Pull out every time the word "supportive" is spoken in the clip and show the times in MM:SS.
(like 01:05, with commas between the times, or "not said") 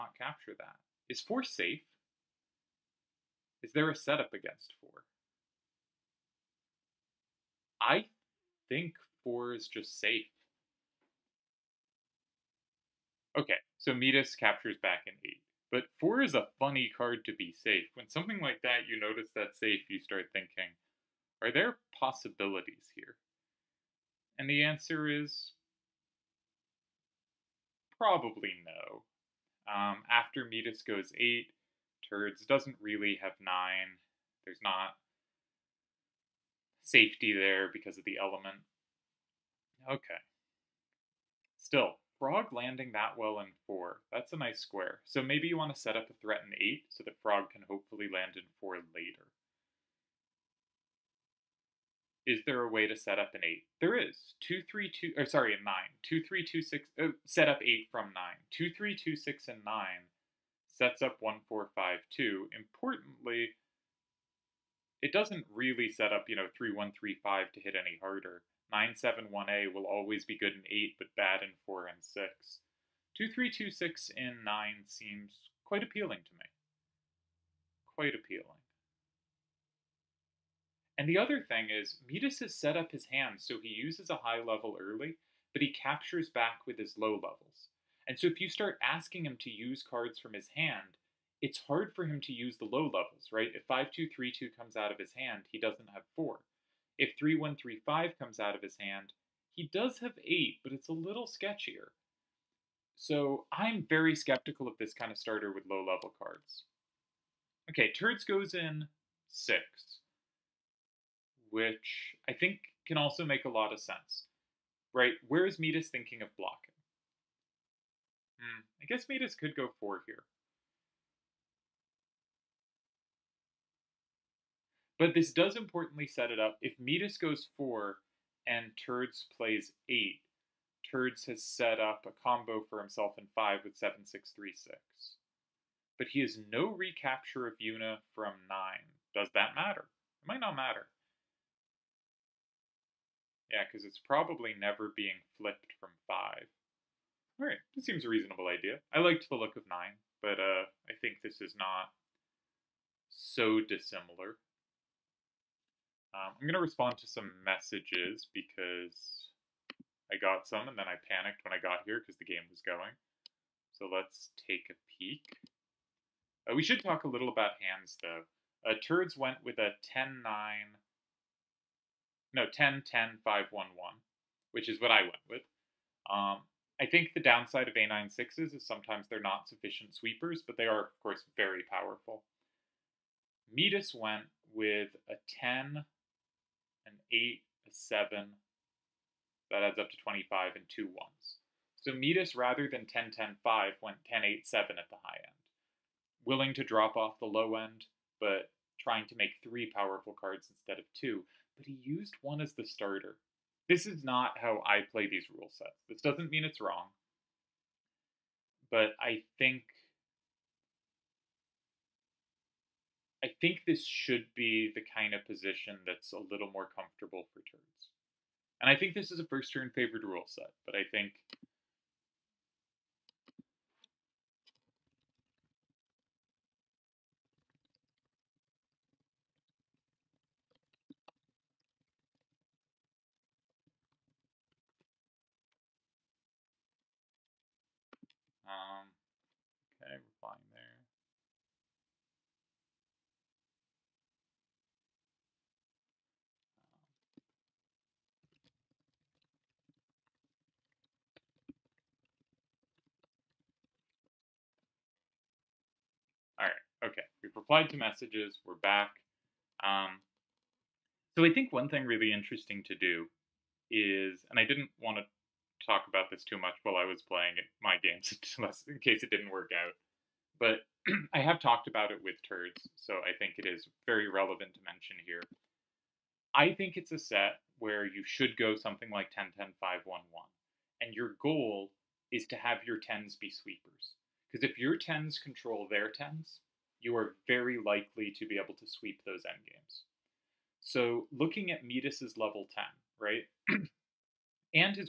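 not said.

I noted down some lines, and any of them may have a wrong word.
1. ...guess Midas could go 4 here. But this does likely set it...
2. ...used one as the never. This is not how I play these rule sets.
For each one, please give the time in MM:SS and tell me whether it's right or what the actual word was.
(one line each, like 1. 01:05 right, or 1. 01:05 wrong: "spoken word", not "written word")
1. 01:58 wrong: "importantly", not "likely"
2. 03:21 wrong: "starter", not "never".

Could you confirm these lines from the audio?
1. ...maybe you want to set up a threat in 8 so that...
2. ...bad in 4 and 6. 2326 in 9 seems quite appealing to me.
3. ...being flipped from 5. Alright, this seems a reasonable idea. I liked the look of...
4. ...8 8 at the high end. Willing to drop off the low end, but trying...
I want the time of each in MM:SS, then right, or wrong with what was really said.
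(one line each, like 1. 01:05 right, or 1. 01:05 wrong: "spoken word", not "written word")
1. 00:45 right
2. 01:11 right
3. 02:24 right
4. 03:14 wrong: "7", not "8".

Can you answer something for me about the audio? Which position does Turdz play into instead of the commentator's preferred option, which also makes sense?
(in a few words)
6.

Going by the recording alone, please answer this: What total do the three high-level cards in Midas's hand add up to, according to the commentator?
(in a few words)
25.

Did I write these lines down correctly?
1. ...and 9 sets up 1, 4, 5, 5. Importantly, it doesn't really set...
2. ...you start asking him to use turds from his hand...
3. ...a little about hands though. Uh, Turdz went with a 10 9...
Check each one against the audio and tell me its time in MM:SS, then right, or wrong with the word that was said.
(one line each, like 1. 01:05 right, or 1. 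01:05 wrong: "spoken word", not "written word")
1. 00:59 wrong: "2", not "5"
2. 01:28 wrong: "cards", not "turds"
3. 02:47 right.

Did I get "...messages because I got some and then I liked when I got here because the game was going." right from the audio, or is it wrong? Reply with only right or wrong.
wrong.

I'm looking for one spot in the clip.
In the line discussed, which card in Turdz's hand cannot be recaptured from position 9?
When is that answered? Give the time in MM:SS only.
02:17.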